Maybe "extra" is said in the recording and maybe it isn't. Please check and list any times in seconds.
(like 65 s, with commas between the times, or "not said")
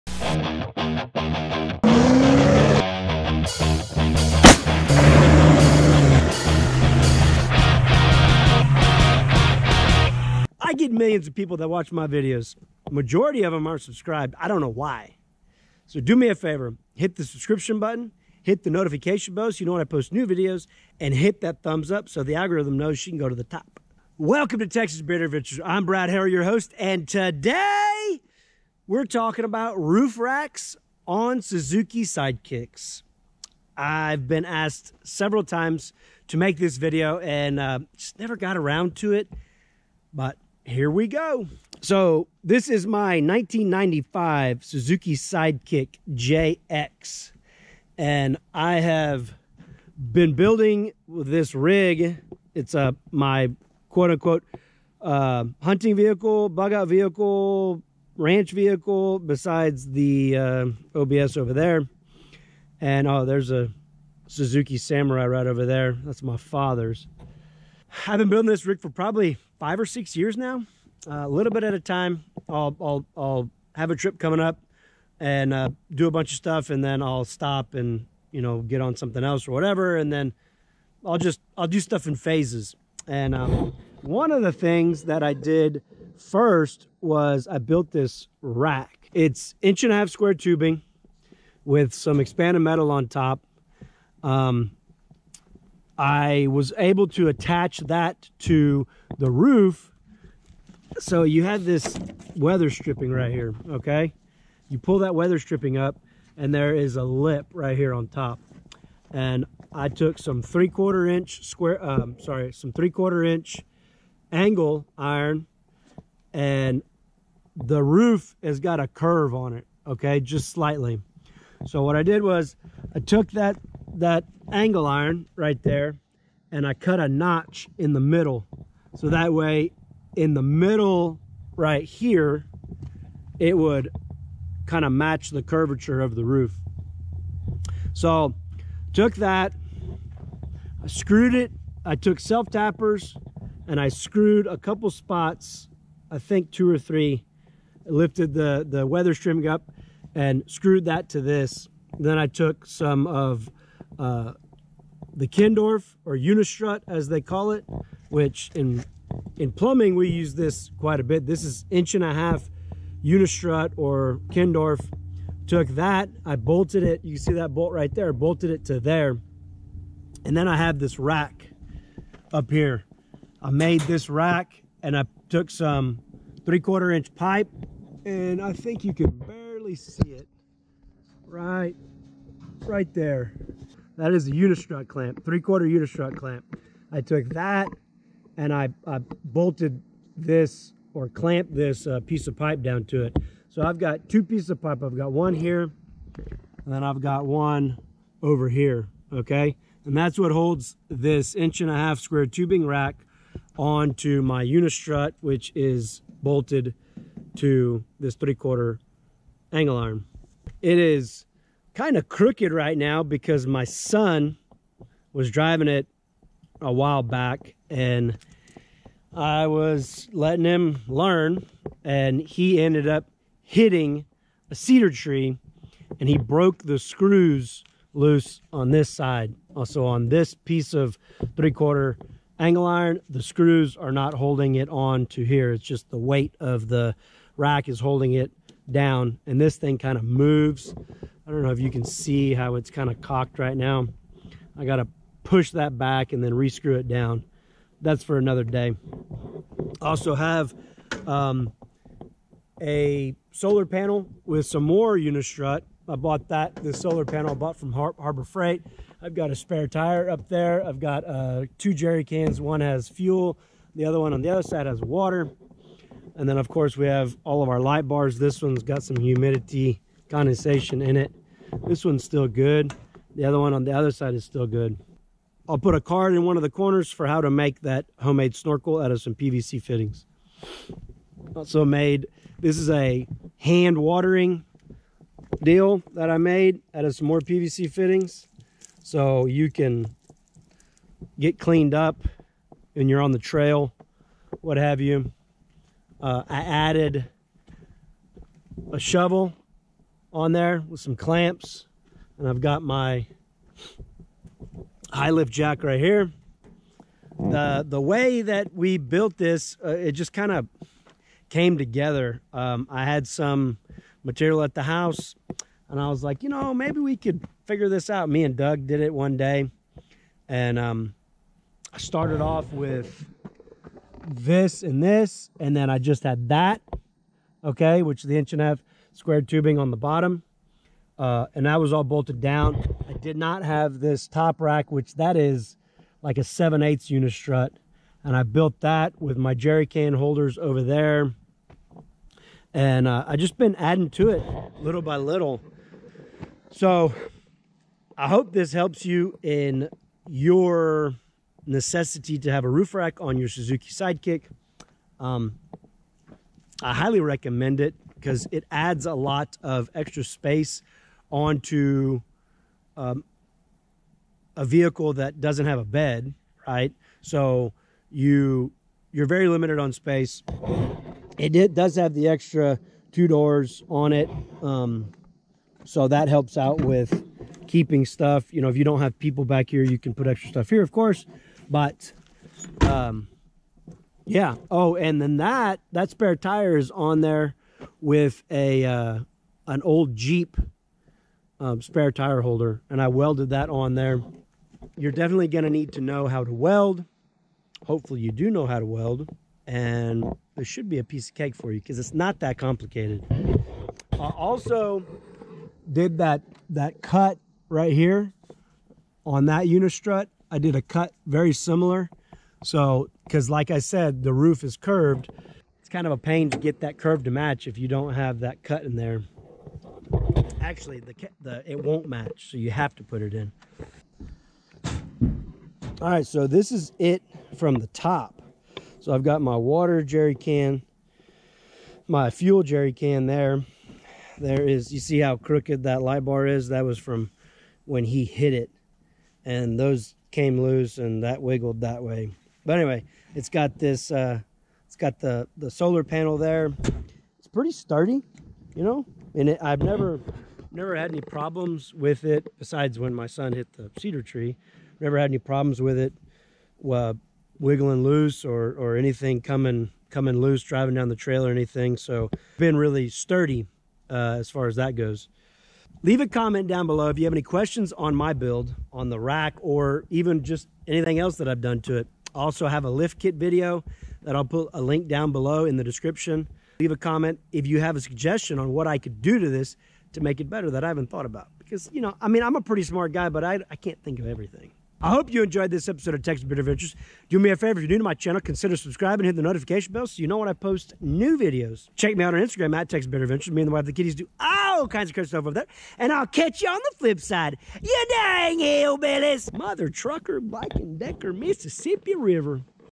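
359 s, 372 s, 380 s.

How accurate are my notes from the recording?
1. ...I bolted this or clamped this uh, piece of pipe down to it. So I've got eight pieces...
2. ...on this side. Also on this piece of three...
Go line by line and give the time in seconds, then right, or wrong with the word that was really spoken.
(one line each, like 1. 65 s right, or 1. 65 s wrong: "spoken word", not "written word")
1. 188 s wrong: "two", not "eight"
2. 228 s right.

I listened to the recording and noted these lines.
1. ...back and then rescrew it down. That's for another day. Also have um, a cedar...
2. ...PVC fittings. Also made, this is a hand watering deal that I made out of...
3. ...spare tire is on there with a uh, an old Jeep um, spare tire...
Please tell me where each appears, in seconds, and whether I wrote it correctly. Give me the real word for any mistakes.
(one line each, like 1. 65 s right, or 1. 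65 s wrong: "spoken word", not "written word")
1. 245 s wrong: "solar", not "cedar"
2. 279 s right
3. 385 s right.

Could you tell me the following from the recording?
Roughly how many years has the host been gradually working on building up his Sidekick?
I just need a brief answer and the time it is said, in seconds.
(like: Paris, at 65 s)
5 or 6, at 69 s.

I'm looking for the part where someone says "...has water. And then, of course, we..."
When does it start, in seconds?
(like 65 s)
264 s.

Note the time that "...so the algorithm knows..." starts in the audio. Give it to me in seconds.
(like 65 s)
22 s.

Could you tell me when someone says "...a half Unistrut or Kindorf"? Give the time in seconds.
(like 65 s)
162 s.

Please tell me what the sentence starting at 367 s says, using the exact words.
So you you're very limited on space.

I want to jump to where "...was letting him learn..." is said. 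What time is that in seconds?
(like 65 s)
219 s.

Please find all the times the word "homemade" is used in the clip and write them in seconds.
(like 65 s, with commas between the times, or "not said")
277 s.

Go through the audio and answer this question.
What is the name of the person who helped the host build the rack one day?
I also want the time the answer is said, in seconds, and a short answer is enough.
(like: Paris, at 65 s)
Doug, at 318 s.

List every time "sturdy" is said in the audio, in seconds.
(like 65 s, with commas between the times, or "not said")
447 s, 462 s.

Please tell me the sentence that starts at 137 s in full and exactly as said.
So took that, I screwed it.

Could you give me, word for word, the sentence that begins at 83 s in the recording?
And um, one of the things that I did first was I built this rack.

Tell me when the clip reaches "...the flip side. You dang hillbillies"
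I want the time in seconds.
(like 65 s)
496 s.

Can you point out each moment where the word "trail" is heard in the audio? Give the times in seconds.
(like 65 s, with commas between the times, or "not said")
293 s, 460 s.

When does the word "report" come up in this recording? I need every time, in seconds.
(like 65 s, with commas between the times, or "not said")
not said.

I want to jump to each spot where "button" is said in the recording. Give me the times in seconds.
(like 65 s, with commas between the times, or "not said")
17 s.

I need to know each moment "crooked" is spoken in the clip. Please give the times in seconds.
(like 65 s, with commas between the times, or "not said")
212 s, 435 s.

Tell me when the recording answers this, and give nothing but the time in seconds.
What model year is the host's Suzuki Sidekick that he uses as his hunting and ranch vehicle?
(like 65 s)
43 s.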